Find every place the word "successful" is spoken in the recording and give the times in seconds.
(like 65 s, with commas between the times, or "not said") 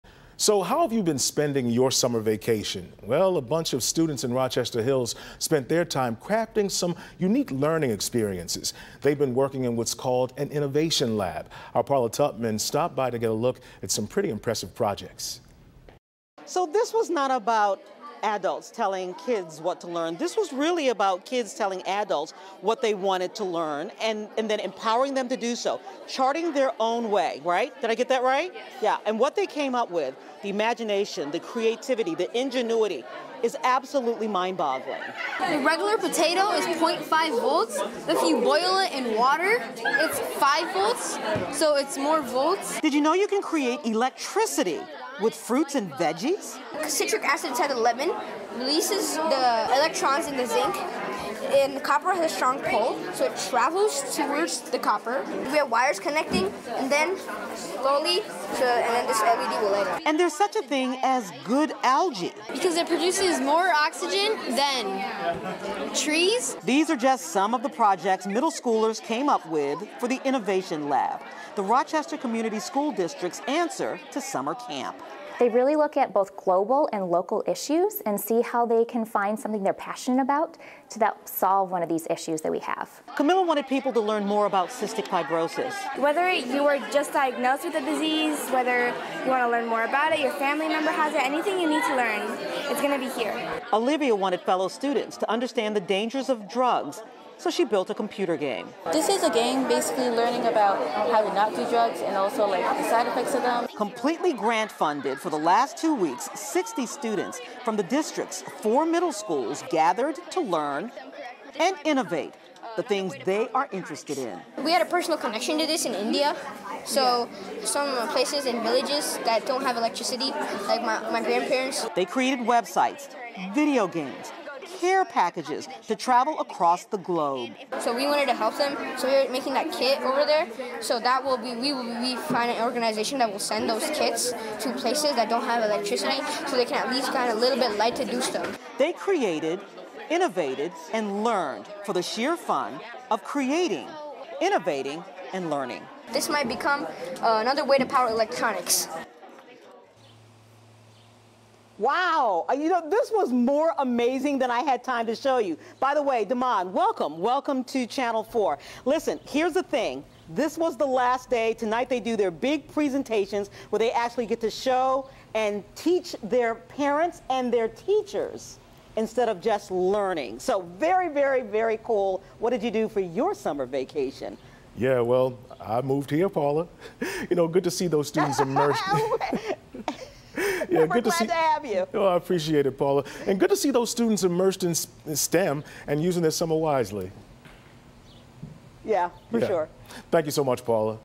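not said.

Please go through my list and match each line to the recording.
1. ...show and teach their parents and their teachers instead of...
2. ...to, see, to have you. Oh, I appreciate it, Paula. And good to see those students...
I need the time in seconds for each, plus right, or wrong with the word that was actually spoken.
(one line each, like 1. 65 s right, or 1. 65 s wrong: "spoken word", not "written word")
1. 164 s right
2. 181 s right.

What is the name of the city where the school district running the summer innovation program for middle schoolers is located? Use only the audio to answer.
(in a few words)
Rochester Hills.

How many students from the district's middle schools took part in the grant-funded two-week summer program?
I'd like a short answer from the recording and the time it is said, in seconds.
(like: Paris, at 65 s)
60, at 106 s.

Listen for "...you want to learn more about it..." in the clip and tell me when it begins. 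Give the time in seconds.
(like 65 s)
89 s.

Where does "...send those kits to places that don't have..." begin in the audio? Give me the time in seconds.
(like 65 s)
133 s.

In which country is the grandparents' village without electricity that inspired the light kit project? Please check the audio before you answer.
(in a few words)
India.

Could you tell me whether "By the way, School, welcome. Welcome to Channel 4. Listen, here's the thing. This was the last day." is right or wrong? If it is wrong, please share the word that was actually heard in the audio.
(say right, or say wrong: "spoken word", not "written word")
wrong: "Damon", not "School".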